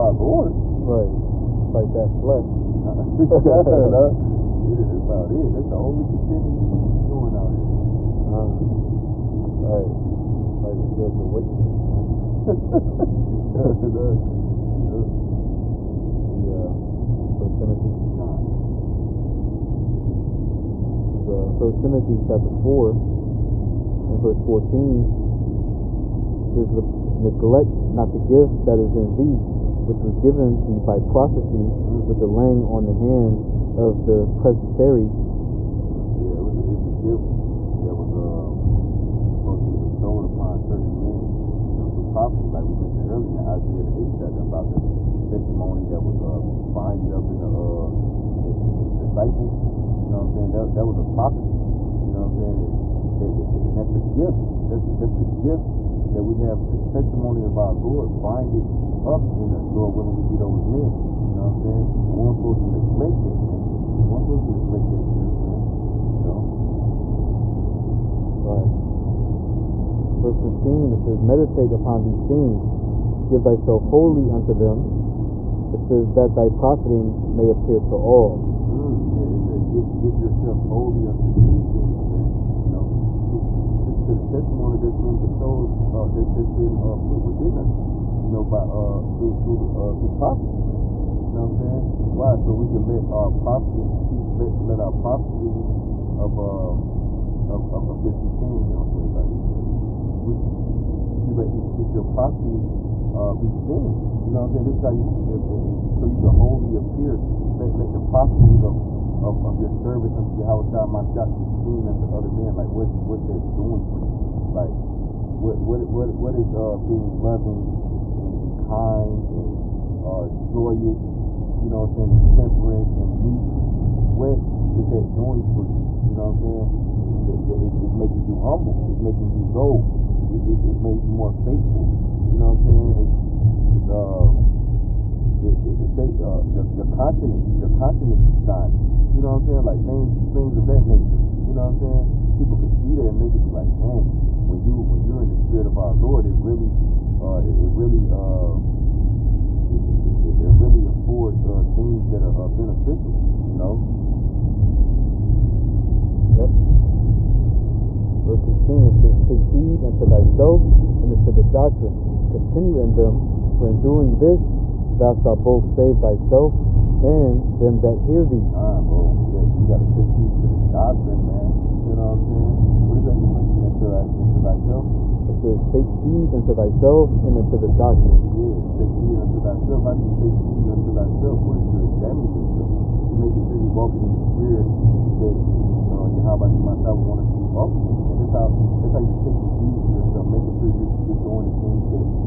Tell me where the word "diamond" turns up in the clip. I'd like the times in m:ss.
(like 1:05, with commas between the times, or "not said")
not said.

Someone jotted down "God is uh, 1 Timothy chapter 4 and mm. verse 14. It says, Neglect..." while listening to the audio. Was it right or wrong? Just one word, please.
right.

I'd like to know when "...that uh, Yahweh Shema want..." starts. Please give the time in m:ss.
3:05.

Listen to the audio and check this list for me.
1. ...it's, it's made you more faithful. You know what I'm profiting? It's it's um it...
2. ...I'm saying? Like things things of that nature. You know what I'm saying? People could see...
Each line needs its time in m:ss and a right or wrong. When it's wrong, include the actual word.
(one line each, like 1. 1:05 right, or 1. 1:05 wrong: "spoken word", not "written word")
1. 2:10 wrong: "saying", not "profiting"
2. 2:19 right.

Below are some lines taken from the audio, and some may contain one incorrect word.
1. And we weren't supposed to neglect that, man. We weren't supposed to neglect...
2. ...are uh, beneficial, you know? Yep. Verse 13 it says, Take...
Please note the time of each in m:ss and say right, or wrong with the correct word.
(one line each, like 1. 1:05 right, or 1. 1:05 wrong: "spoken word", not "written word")
1. 1:01 right
2. 2:32 wrong: "16", not "13".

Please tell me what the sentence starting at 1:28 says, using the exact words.
You know, by uh, through through uh, through prophecy, man.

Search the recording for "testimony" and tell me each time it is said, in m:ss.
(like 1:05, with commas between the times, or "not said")
0:45, 0:56, 1:24.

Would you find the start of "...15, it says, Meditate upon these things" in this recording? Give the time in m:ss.
1:10.